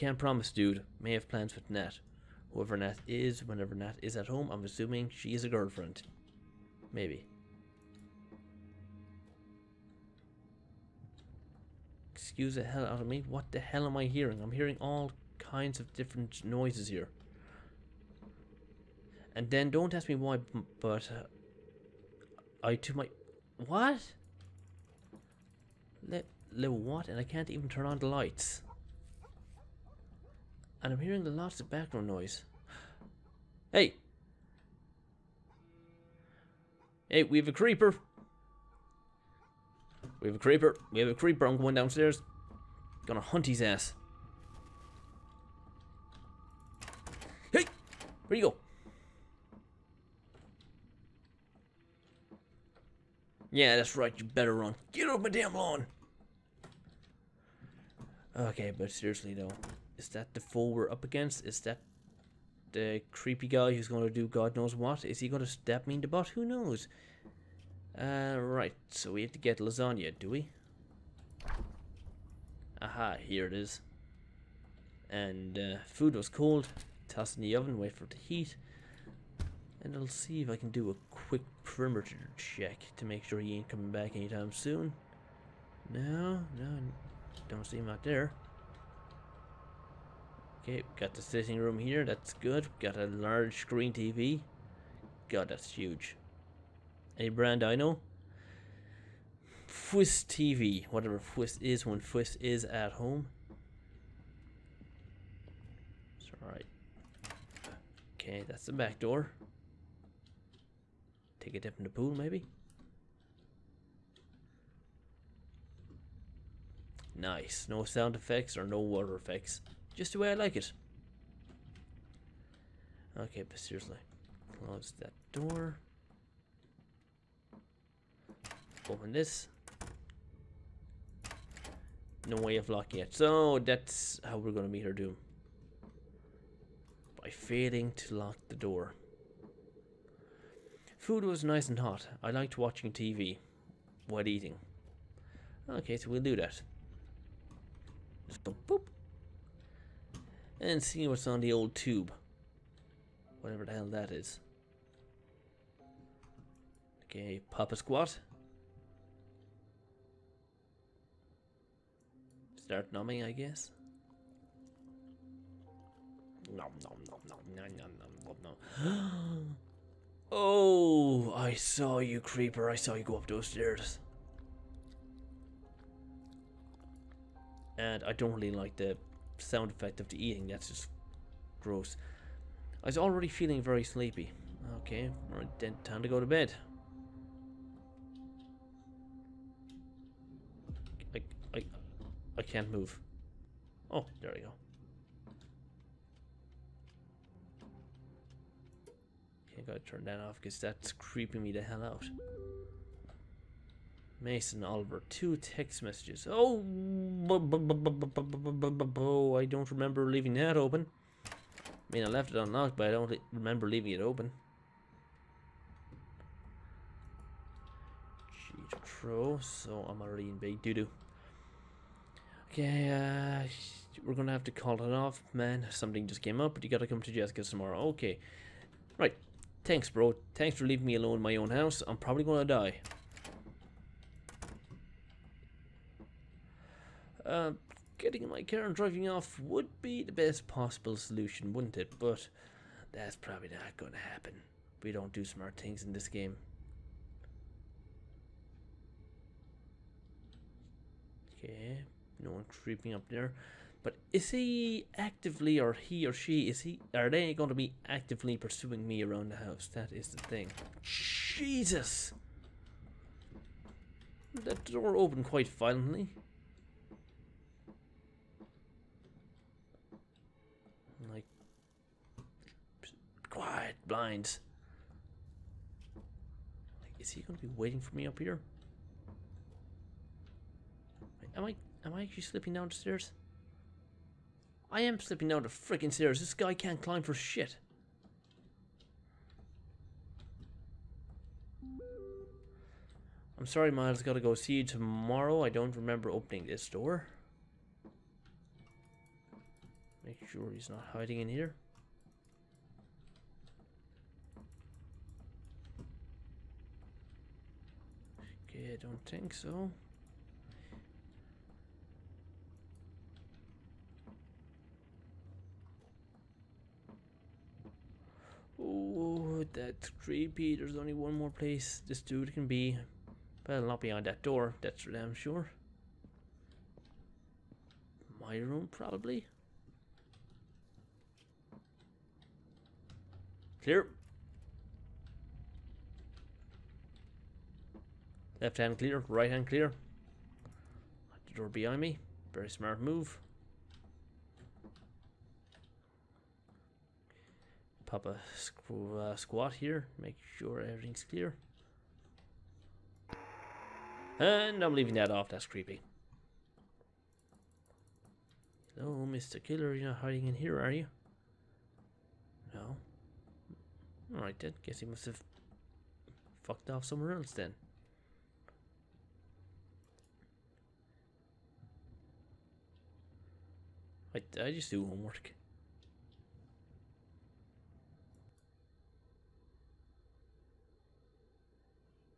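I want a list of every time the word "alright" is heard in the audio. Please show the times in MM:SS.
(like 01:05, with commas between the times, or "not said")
01:46, 06:04.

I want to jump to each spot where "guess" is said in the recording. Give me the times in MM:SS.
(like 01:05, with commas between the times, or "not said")
02:43, 06:04.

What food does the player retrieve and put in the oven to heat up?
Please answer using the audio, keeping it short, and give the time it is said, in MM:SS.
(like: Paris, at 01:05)
Lasagna, at 01:09.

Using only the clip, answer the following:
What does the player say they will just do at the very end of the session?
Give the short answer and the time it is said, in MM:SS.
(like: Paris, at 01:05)
Homework, at 06:14.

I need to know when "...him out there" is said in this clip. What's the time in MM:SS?
01:27.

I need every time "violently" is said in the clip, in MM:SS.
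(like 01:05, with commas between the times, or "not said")
04:25.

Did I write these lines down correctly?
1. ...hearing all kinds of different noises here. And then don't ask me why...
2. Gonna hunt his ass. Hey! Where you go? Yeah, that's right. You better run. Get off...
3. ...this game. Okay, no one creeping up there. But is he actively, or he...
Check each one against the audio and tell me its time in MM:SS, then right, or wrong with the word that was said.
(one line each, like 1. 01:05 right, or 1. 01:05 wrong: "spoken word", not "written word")
1. 00:14 right
2. 00:43 right
3. 04:05 right.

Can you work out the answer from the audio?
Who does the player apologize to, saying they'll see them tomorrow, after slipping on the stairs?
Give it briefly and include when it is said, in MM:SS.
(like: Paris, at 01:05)
Miles, at 04:53.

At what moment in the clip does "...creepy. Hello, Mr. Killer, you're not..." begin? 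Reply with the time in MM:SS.
05:55.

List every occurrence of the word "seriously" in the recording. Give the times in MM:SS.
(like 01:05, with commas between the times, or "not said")
00:58, 02:03.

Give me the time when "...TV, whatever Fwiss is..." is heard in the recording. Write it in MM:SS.
01:40.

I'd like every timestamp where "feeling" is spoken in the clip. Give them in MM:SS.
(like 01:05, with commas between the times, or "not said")
03:03.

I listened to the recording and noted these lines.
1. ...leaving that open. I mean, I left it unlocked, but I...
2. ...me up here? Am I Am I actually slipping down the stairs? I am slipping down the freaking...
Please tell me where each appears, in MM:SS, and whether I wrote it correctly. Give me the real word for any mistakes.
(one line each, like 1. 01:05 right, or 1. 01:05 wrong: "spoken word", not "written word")
1. 03:30 right
2. 04:37 right.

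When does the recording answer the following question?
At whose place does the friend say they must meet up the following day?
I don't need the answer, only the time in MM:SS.
03:47.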